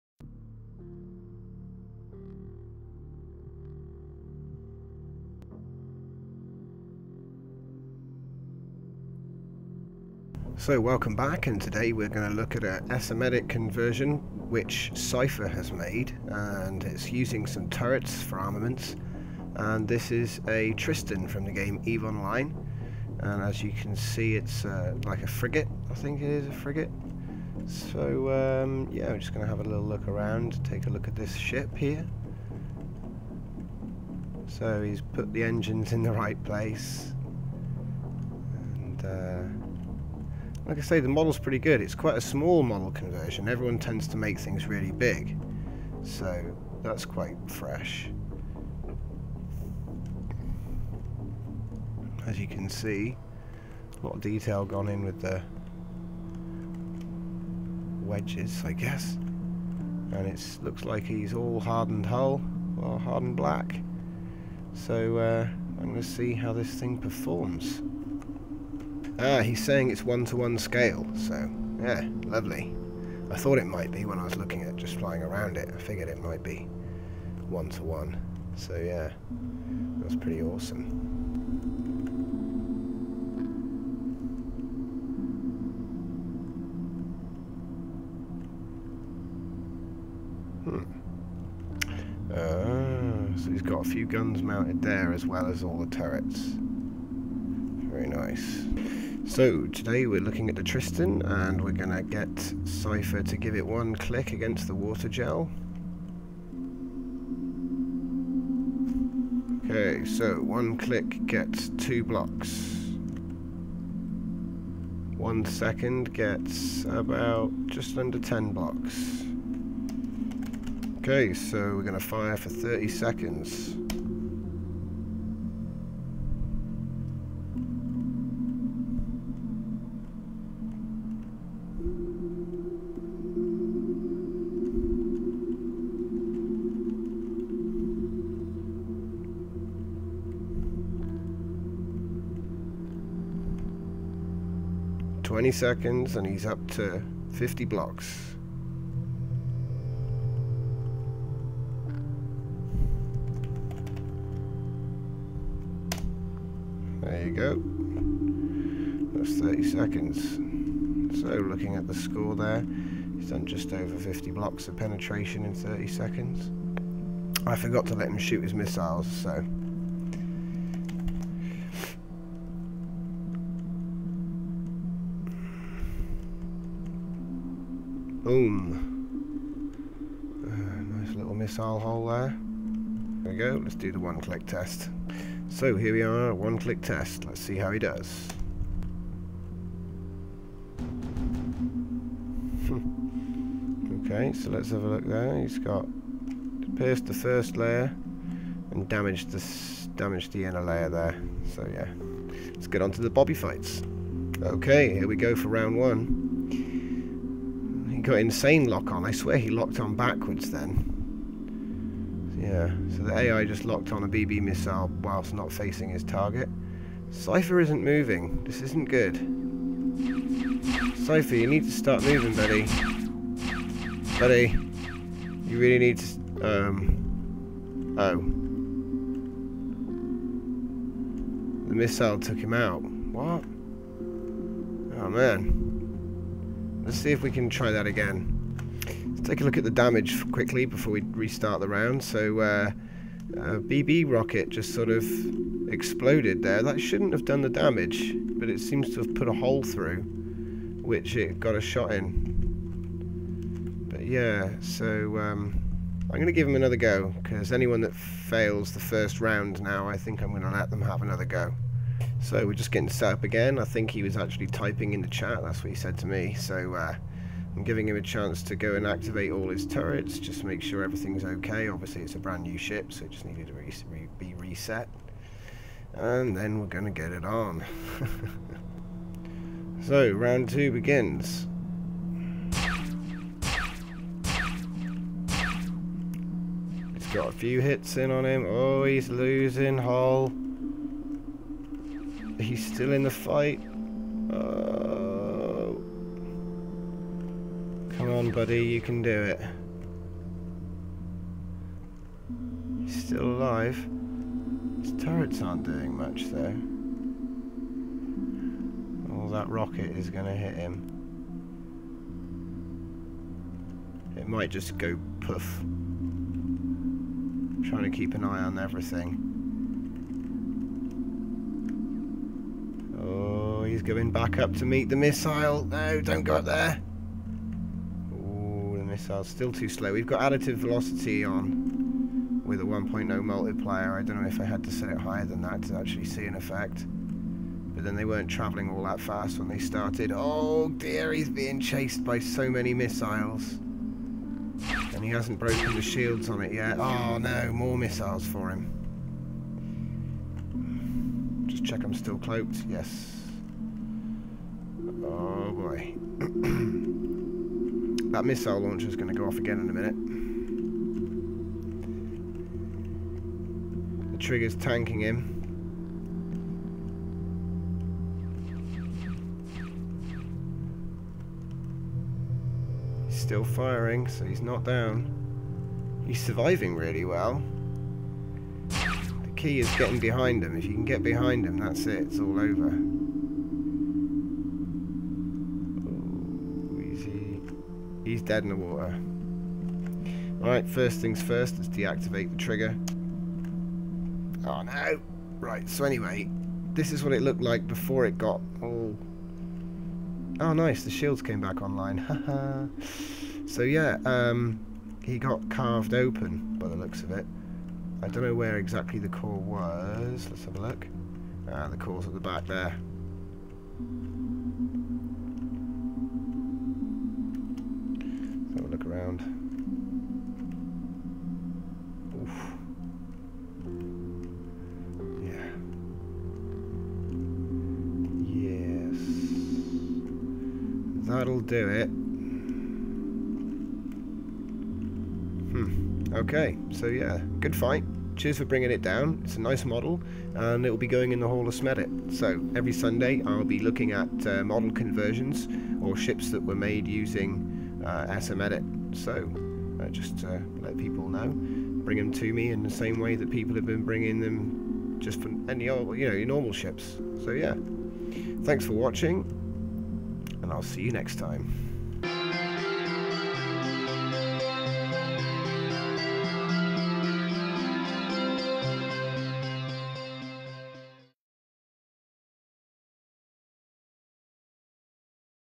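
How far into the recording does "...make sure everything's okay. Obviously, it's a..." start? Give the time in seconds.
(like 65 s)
270 s.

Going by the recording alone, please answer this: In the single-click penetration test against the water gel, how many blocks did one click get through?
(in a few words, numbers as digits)
2.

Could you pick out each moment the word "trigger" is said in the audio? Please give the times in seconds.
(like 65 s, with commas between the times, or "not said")
364 s, 392 s.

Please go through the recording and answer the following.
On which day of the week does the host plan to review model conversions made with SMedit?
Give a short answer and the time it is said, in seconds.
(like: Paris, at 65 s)
Sunday, at 442 s.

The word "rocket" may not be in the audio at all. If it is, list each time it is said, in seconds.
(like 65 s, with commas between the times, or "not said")
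244 s, 309 s.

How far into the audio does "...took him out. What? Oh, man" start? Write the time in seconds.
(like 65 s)
232 s.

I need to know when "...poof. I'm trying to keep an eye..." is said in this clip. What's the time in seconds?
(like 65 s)
315 s.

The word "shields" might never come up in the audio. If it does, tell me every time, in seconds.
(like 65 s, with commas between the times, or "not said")
345 s, 400 s.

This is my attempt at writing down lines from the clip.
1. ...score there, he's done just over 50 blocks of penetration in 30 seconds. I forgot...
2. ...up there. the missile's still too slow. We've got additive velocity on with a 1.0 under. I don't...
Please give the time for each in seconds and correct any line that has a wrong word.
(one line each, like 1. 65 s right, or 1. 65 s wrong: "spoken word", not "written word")
1. 161 s right
2. 326 s wrong: "multiplier", not "under".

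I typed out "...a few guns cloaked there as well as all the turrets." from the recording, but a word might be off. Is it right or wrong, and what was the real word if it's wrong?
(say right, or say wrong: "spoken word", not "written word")
wrong: "mounted", not "cloaked".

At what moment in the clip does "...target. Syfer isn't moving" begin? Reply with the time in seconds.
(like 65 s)
216 s.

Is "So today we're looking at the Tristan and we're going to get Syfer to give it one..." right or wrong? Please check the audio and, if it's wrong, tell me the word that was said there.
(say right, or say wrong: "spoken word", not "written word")
right.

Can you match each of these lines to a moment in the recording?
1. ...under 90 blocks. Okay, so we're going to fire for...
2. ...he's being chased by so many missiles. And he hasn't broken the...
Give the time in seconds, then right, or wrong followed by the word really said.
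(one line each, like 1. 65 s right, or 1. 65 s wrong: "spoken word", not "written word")
1. 117 s wrong: "10", not "90"
2. 341 s right.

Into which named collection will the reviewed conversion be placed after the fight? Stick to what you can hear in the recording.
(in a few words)
Hall of Smedit.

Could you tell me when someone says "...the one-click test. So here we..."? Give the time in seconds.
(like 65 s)
183 s.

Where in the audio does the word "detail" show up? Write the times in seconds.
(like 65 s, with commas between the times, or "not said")
54 s.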